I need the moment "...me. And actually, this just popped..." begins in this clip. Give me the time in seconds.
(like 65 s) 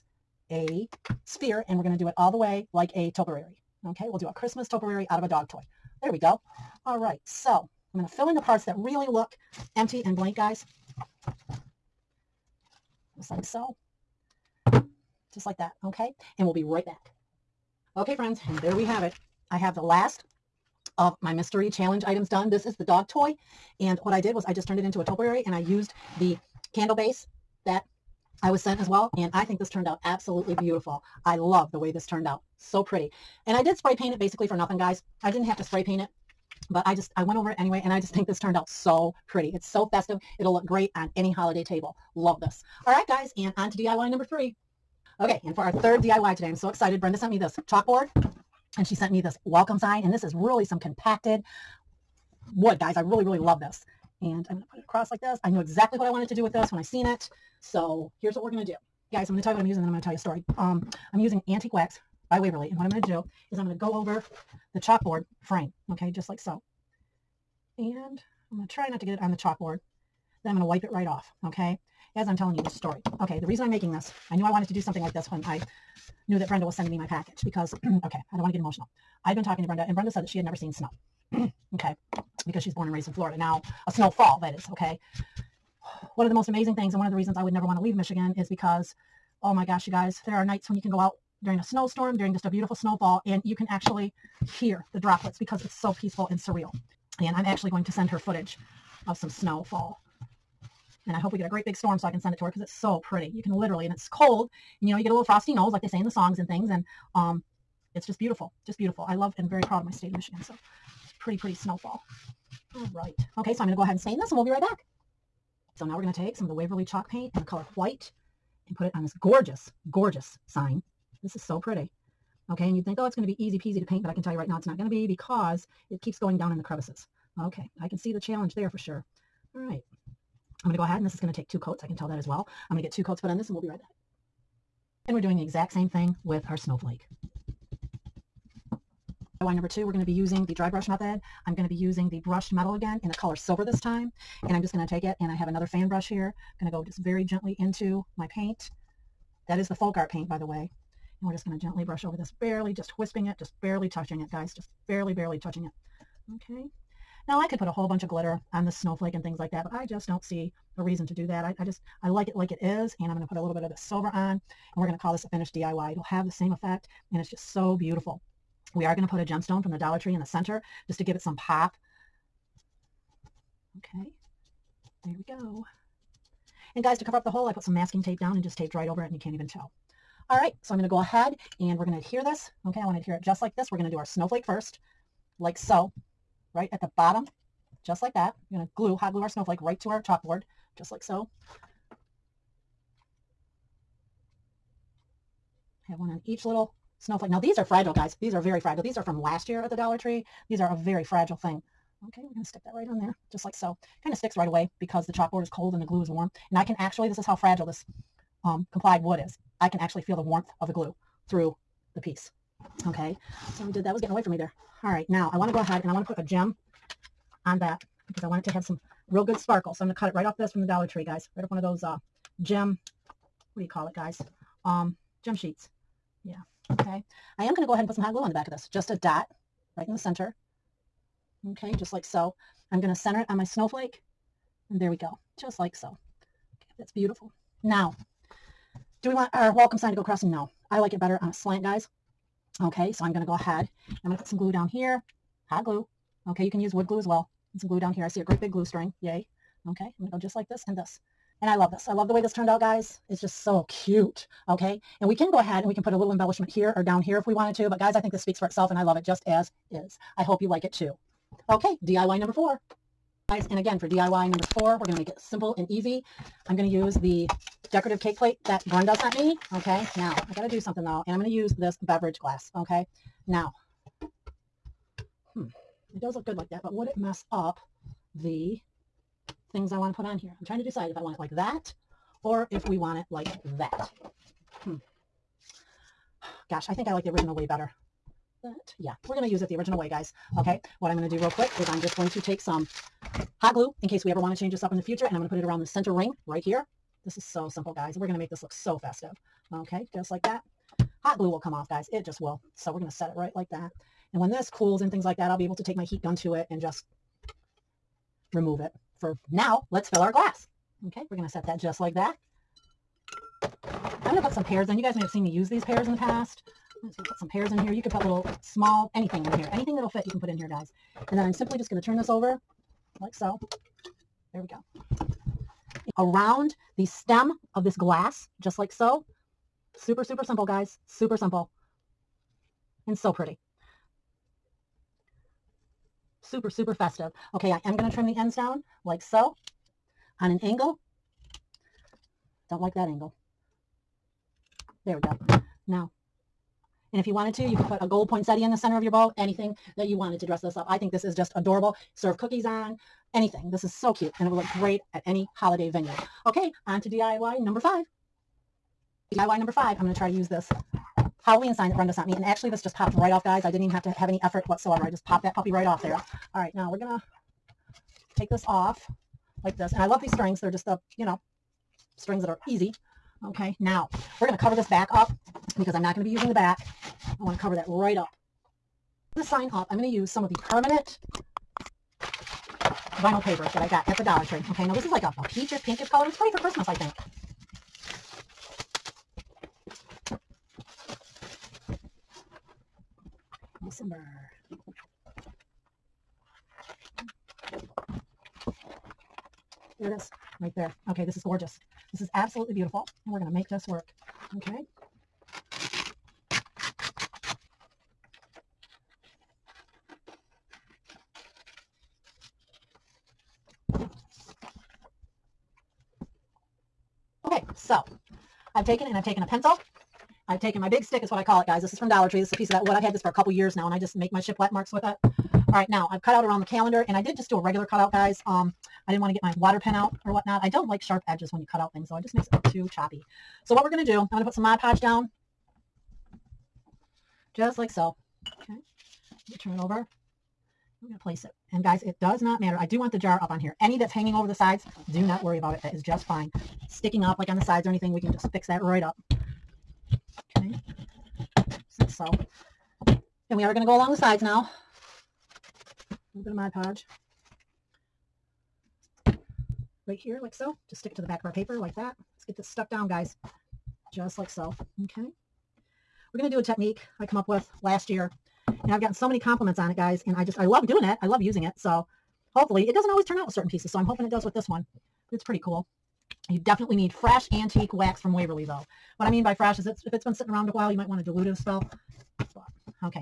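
362 s.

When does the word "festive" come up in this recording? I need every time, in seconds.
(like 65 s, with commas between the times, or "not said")
39 s, 298 s, 336 s.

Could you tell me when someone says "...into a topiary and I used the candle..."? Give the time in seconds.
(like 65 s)
24 s.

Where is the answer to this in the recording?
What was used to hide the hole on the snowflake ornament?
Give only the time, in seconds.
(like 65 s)
177 s.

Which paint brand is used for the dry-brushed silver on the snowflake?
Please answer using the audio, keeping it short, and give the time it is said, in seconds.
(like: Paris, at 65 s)
Folk Art, at 149 s.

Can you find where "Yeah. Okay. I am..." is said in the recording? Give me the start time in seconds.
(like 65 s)
226 s.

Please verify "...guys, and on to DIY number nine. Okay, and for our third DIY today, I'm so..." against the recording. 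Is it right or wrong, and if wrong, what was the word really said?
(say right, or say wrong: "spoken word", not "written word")
wrong: "three", not "nine".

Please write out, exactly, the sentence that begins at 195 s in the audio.
I have one on each little snowflake.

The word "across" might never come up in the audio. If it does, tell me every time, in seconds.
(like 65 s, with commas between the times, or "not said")
54 s, 240 s.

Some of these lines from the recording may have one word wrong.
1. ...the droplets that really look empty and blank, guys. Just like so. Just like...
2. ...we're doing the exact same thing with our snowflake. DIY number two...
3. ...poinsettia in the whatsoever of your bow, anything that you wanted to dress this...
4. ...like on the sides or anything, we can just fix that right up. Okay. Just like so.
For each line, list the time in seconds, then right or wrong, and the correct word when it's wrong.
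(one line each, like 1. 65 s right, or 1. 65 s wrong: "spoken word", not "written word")
1. 8 s wrong: "parts", not "droplets"
2. 135 s right
3. 348 s wrong: "center", not "whatsoever"
4. 447 s right.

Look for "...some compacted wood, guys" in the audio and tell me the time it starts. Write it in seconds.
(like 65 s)
50 s.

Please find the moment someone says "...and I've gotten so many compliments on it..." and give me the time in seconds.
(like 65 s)
468 s.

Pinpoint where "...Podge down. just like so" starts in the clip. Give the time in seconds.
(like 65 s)
434 s.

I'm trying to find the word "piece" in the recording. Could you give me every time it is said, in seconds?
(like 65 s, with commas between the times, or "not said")
211 s, 422 s, 473 s.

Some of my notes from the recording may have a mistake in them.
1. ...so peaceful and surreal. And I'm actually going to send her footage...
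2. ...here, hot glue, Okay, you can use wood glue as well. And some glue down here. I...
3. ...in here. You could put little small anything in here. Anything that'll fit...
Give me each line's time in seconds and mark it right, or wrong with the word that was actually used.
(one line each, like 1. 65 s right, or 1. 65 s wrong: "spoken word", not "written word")
1. 95 s right
2. 244 s right
3. 317 s right.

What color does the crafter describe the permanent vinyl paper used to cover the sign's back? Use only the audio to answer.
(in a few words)
Peachish pinkish.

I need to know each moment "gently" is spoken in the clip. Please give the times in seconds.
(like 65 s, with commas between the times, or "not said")
147 s, 151 s.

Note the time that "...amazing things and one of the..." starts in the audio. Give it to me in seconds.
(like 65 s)
86 s.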